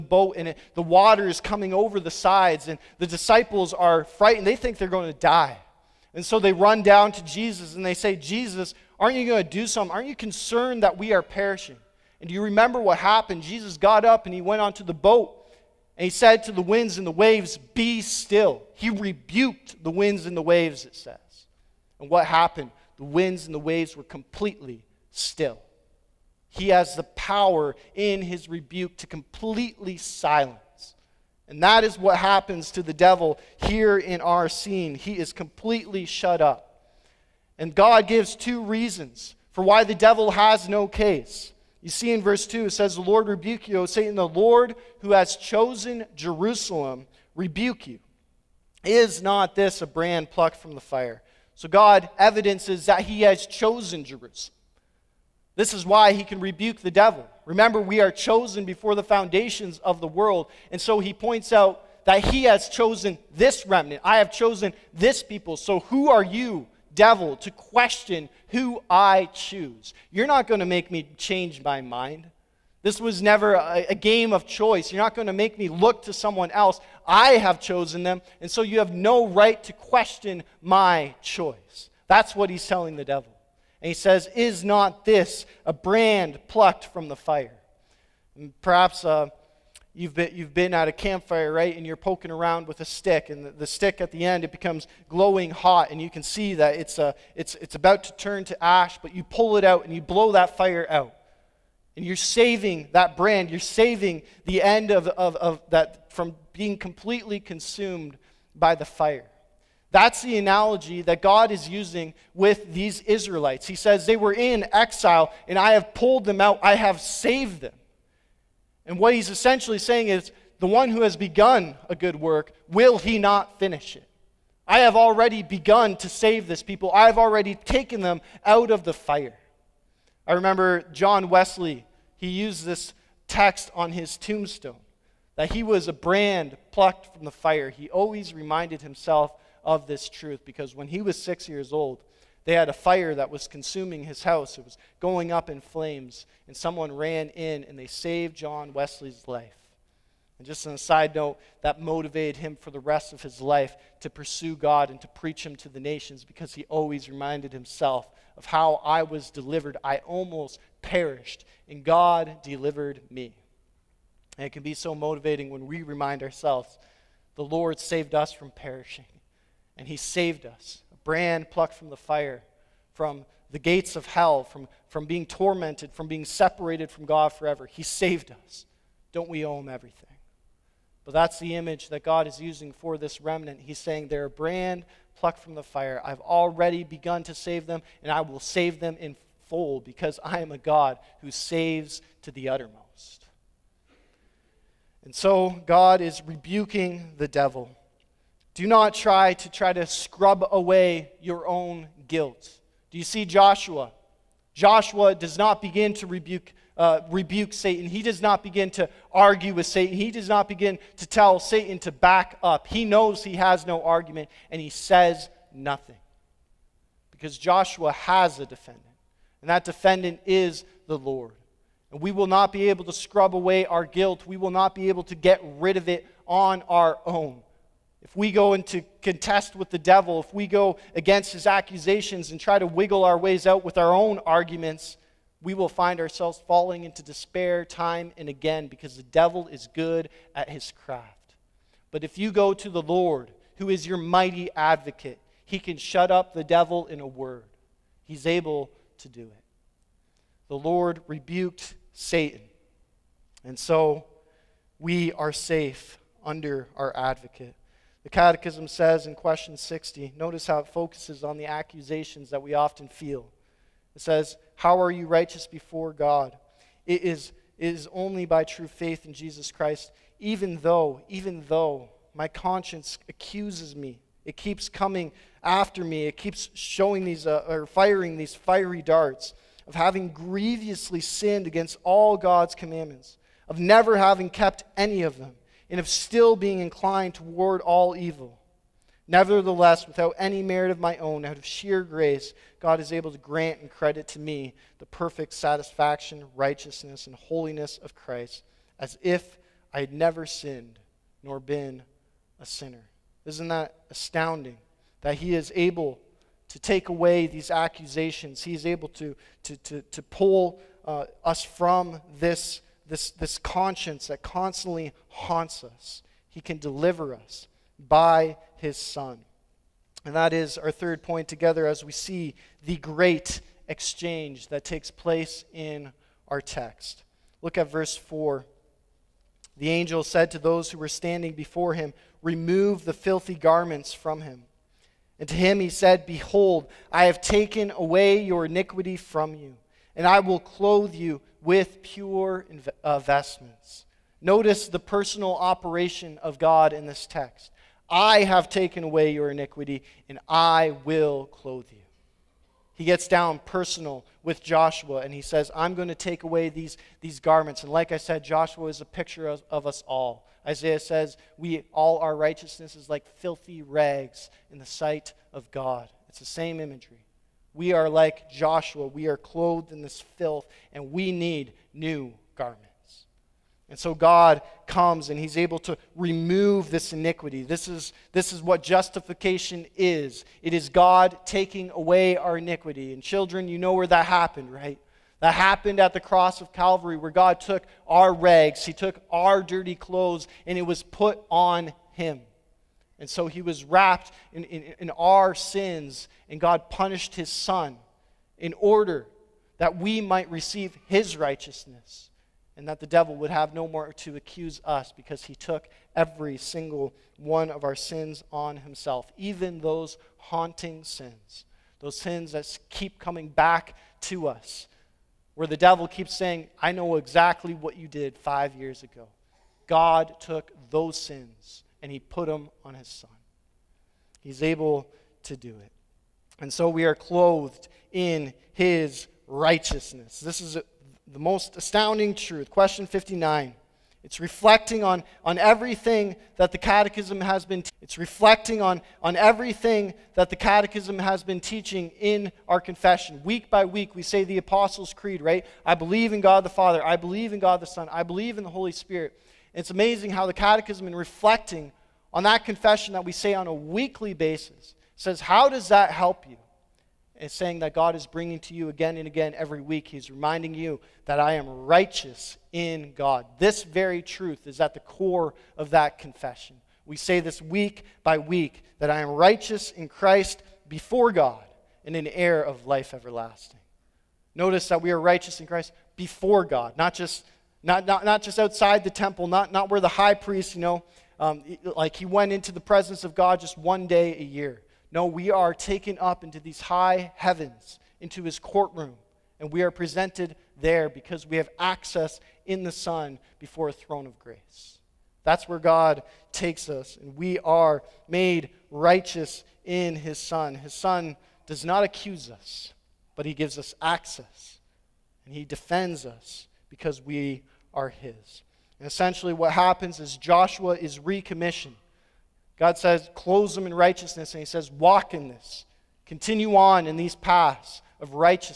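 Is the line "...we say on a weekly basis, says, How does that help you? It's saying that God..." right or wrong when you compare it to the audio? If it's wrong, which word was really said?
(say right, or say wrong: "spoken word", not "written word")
right.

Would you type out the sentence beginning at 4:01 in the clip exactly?
But if you go to the Lord, who is your mighty advocate, he can shut up the devil in a word.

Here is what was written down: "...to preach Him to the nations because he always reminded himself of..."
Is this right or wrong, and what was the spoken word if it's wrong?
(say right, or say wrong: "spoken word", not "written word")
right.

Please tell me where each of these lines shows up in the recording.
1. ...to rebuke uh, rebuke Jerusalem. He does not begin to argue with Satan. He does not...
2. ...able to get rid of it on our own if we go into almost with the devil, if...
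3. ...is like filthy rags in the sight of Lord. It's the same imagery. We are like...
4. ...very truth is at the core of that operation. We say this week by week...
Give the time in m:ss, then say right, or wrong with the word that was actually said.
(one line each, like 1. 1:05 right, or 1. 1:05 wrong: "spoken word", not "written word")
1. 3:25 wrong: "Satan", not "Jerusalem"
2. 3:44 wrong: "contest", not "almost"
3. 6:02 wrong: "God", not "Lord"
4. 7:43 wrong: "confession", not "operation".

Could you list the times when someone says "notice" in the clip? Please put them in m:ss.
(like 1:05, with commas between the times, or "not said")
4:20, 5:44, 7:54.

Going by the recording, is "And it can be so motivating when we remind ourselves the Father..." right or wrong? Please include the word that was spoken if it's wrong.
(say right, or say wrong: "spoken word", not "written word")
wrong: "Lord", not "Father".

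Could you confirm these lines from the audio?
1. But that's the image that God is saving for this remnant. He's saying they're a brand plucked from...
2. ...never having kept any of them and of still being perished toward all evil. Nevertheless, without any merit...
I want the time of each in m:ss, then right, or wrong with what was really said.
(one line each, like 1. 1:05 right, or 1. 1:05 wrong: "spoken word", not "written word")
1. 3:01 wrong: "using", not "saving"
2. 4:43 wrong: "inclined", not "perished".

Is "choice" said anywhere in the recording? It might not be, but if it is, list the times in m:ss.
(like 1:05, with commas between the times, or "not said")
1:14, 1:21.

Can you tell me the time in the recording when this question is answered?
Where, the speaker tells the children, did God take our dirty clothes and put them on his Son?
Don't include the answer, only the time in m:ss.
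6:25.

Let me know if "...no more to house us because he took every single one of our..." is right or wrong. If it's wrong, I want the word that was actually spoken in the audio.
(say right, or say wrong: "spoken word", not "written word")
wrong: "accuse", not "house".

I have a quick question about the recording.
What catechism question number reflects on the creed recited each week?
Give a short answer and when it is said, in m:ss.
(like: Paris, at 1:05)
59, at 7:12.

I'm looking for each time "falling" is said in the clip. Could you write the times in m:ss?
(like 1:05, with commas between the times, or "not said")
3:56.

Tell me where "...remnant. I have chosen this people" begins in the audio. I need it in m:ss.
1:03.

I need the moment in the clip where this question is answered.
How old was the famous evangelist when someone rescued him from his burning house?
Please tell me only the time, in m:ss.
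2:21.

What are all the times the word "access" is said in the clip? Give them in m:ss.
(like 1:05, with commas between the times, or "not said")
8:11, 8:23.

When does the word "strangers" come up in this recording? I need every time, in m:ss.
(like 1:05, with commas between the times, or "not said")
not said.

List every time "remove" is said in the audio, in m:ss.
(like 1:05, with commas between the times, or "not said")
5:32, 6:15.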